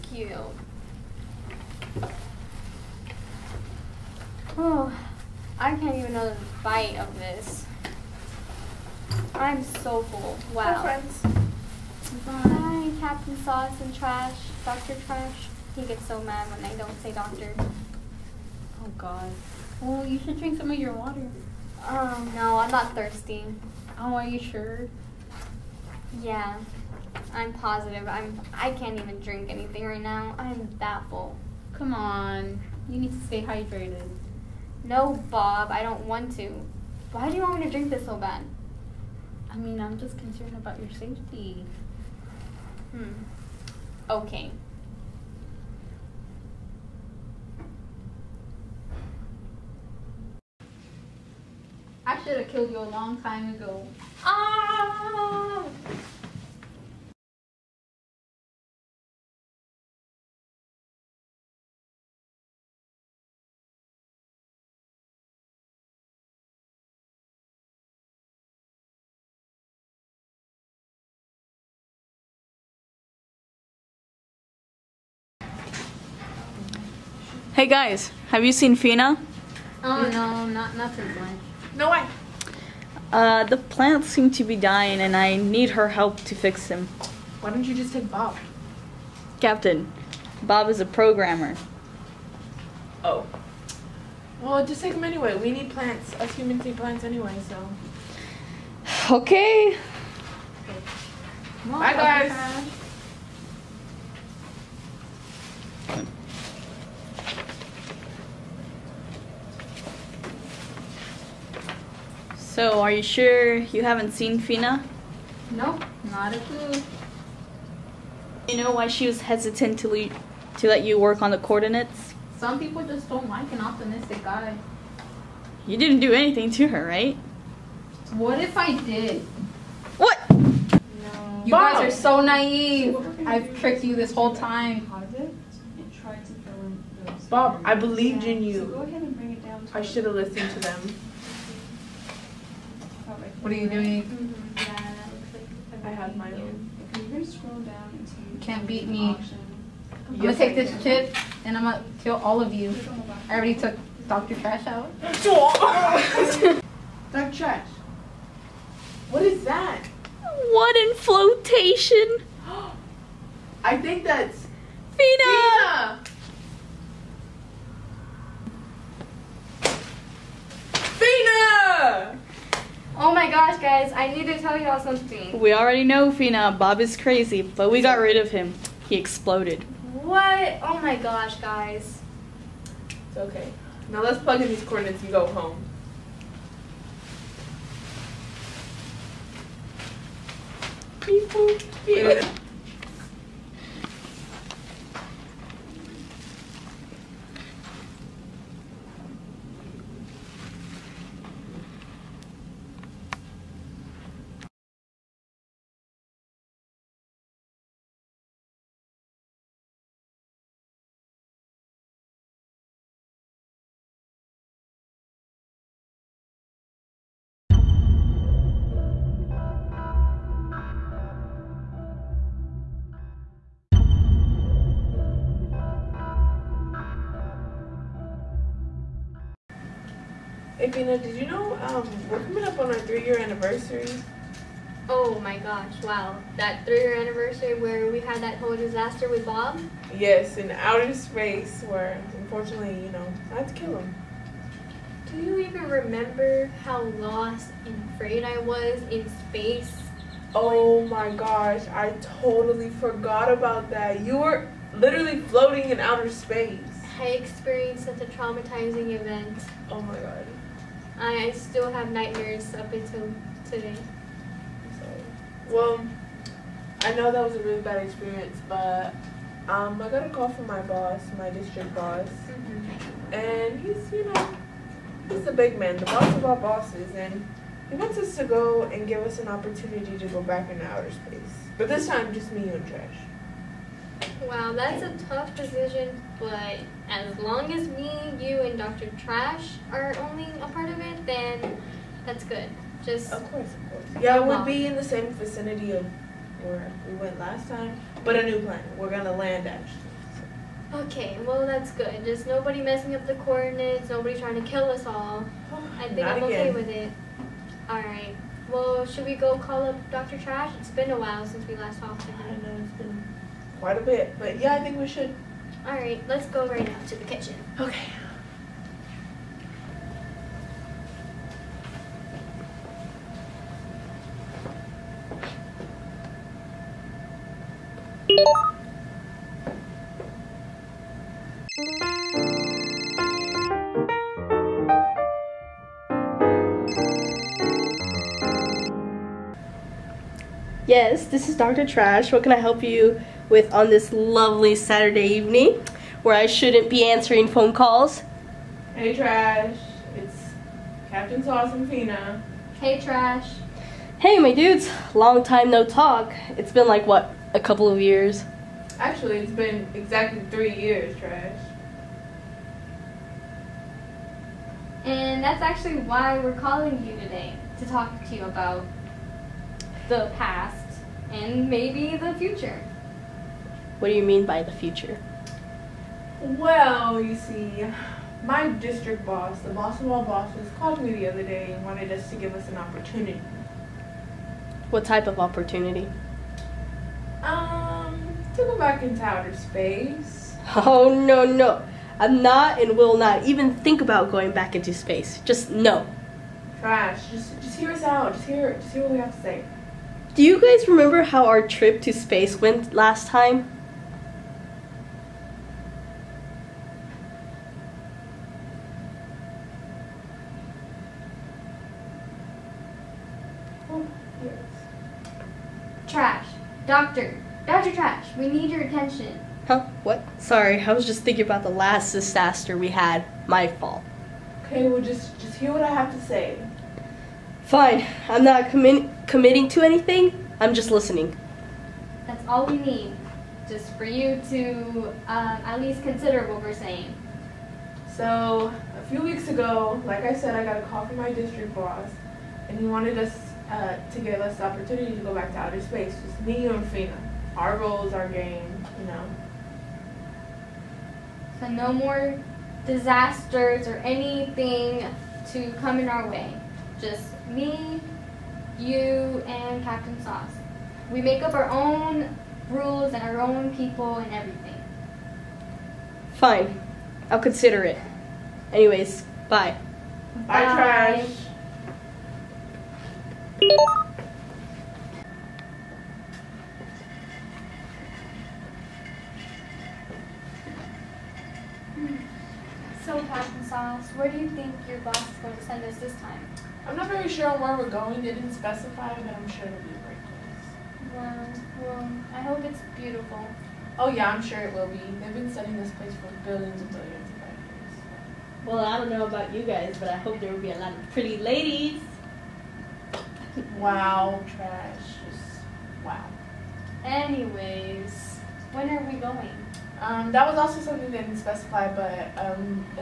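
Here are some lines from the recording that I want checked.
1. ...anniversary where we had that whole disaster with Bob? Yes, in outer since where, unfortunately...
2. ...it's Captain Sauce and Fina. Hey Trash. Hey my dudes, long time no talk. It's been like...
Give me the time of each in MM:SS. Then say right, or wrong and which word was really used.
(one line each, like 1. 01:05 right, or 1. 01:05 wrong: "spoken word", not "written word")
1. 03:56 wrong: "space", not "since"
2. 05:49 right.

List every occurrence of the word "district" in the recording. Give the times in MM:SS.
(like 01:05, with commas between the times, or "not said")
04:31, 06:18, 07:21.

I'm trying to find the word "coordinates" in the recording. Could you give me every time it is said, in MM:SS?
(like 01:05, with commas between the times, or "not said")
02:01, 03:04, 05:03.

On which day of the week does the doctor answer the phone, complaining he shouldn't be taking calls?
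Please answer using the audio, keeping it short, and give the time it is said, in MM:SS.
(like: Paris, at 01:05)
Saturday, at 05:44.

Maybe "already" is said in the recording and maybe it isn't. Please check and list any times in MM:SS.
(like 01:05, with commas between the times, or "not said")
02:33, 02:55.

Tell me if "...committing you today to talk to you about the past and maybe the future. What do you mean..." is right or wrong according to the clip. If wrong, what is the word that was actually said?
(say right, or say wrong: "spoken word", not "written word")
wrong: "calling", not "committing".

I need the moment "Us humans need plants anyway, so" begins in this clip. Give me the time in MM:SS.
01:36.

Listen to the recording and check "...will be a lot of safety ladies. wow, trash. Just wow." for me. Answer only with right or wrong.
wrong.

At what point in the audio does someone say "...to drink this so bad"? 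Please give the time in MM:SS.
00:37.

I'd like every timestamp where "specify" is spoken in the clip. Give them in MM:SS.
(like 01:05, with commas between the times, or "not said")
08:08, 08:31.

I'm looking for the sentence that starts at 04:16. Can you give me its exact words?
I experienced such a traumatizing event.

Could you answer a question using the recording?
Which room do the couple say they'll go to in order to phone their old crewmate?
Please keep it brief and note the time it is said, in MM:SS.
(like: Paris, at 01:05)
Kitchen, at 05:16.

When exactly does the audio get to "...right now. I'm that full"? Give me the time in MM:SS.
00:29.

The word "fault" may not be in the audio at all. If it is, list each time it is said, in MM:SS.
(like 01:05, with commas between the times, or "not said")
07:03.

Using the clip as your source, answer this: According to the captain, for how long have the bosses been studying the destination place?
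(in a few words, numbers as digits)
Billions of years.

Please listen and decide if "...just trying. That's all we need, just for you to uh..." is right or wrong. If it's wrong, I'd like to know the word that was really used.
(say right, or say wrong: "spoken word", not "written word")
wrong: "listening", not "trying".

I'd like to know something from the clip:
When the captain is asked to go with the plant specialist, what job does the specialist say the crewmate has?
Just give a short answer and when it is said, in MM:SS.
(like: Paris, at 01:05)
Programmer, at 01:30.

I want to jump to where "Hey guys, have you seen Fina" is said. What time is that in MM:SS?
01:17.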